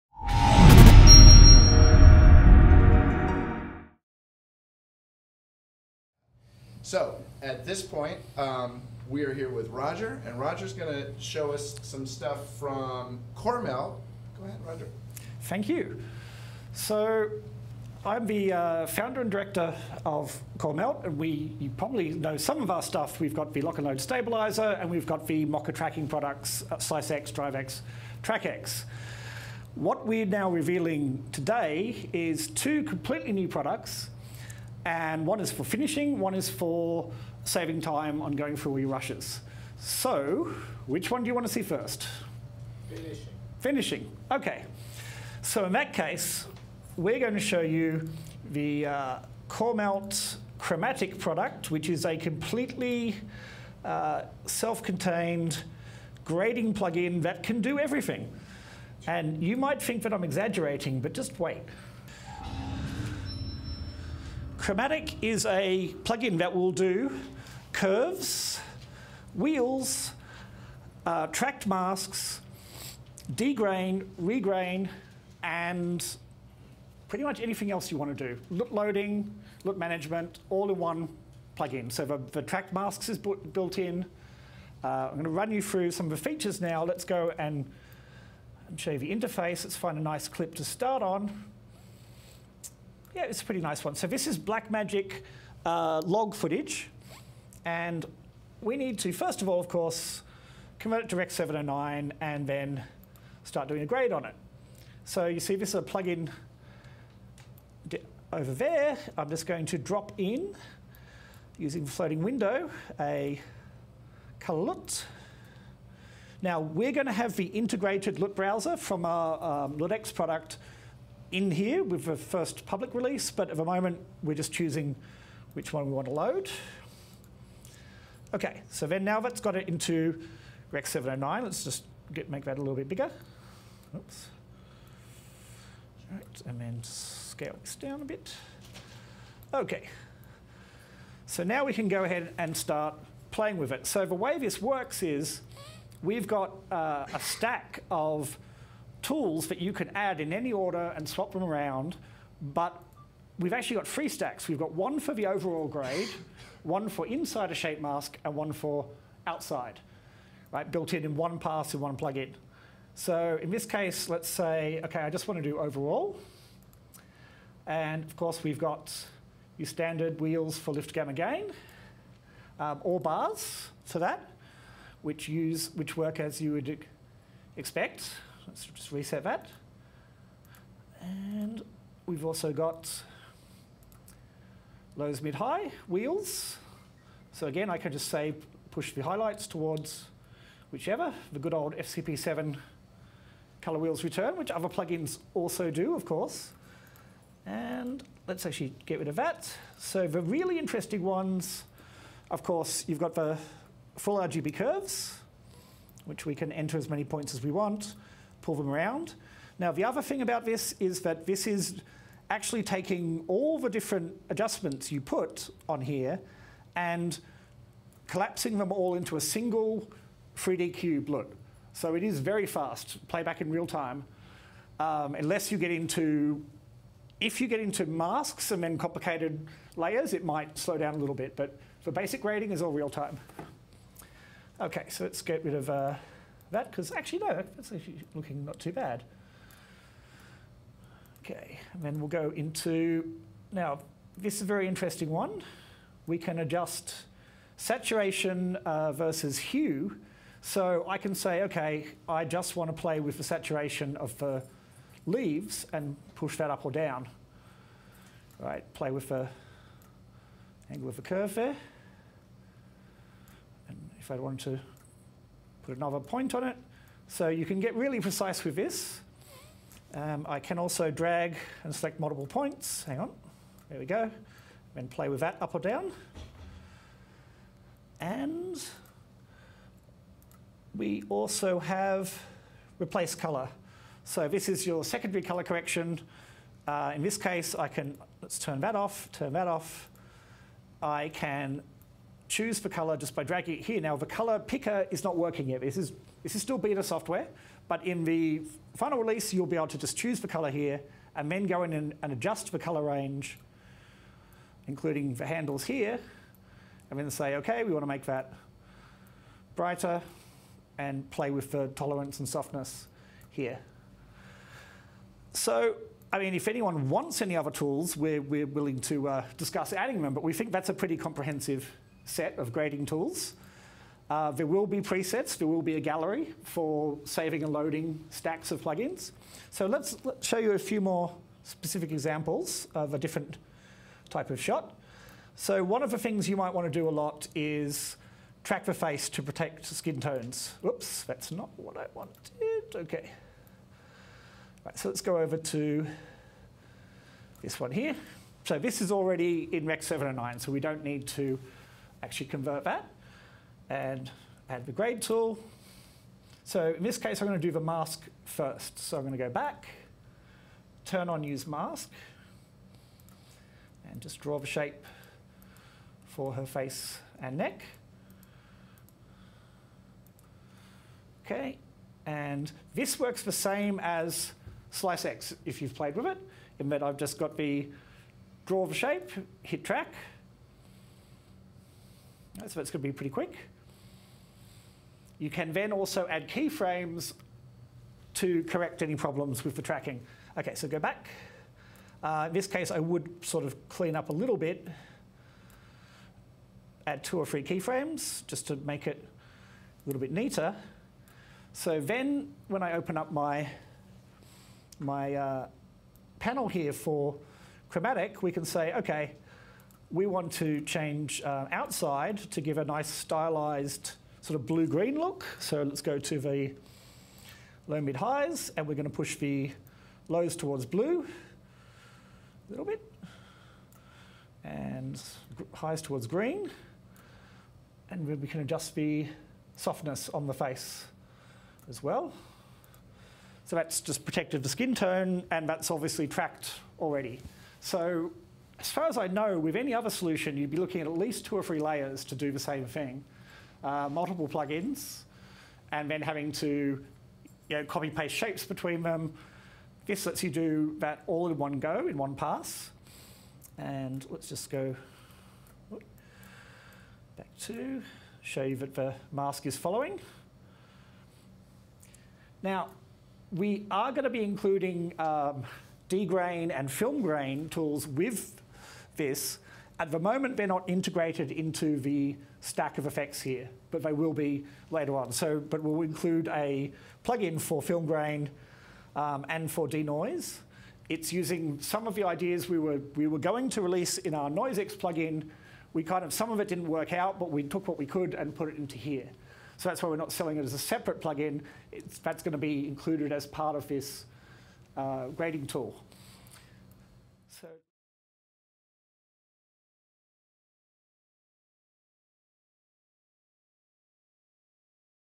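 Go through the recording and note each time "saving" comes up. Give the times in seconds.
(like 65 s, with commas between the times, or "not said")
37 s, 327 s.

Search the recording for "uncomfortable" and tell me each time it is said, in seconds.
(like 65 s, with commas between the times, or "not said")
not said.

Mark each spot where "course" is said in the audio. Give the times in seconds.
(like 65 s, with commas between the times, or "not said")
99 s, 168 s, 196 s, 202 s.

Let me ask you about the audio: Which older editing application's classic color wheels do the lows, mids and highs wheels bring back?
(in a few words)
FCP7.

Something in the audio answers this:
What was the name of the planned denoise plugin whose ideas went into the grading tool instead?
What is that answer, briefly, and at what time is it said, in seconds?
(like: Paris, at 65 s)
NoiseX, at 484 s.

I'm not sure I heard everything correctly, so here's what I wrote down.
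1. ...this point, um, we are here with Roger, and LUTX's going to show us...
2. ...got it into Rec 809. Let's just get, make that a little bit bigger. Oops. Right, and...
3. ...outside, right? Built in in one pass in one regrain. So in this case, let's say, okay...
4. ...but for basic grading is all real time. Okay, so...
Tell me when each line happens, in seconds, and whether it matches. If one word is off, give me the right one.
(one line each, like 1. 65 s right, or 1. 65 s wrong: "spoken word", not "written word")
1. 7 s wrong: "Roger", not "LUTX"
2. 129 s wrong: "709", not "809"
3. 159 s wrong: "plugin", not "regrain"
4. 231 s right.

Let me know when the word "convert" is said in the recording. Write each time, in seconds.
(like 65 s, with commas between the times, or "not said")
100 s, 352 s.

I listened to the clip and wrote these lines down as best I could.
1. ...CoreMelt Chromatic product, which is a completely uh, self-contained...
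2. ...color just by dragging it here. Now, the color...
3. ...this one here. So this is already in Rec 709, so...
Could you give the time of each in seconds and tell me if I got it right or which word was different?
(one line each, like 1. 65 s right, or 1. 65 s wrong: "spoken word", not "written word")
1. 49 s right
2. 292 s right
3. 347 s right.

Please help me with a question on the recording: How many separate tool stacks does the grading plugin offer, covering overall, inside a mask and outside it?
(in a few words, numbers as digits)
3.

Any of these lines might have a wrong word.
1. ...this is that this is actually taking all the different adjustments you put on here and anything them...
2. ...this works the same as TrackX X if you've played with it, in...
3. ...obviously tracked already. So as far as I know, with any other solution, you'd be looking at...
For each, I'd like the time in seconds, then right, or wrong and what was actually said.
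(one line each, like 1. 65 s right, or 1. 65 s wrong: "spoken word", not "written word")
1. 210 s wrong: "collapsing", not "anything"
2. 372 s wrong: "Slice", not "TrackX"
3. 435 s right.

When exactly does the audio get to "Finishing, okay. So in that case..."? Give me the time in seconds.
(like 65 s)
43 s.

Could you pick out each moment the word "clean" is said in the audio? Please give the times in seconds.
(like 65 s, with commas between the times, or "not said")
393 s.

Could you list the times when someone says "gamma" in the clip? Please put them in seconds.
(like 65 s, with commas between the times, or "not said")
170 s.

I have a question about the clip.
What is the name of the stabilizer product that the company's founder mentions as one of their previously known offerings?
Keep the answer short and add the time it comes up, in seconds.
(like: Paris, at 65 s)
Lock and Load, at 23 s.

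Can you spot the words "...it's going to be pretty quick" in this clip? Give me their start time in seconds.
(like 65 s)
382 s.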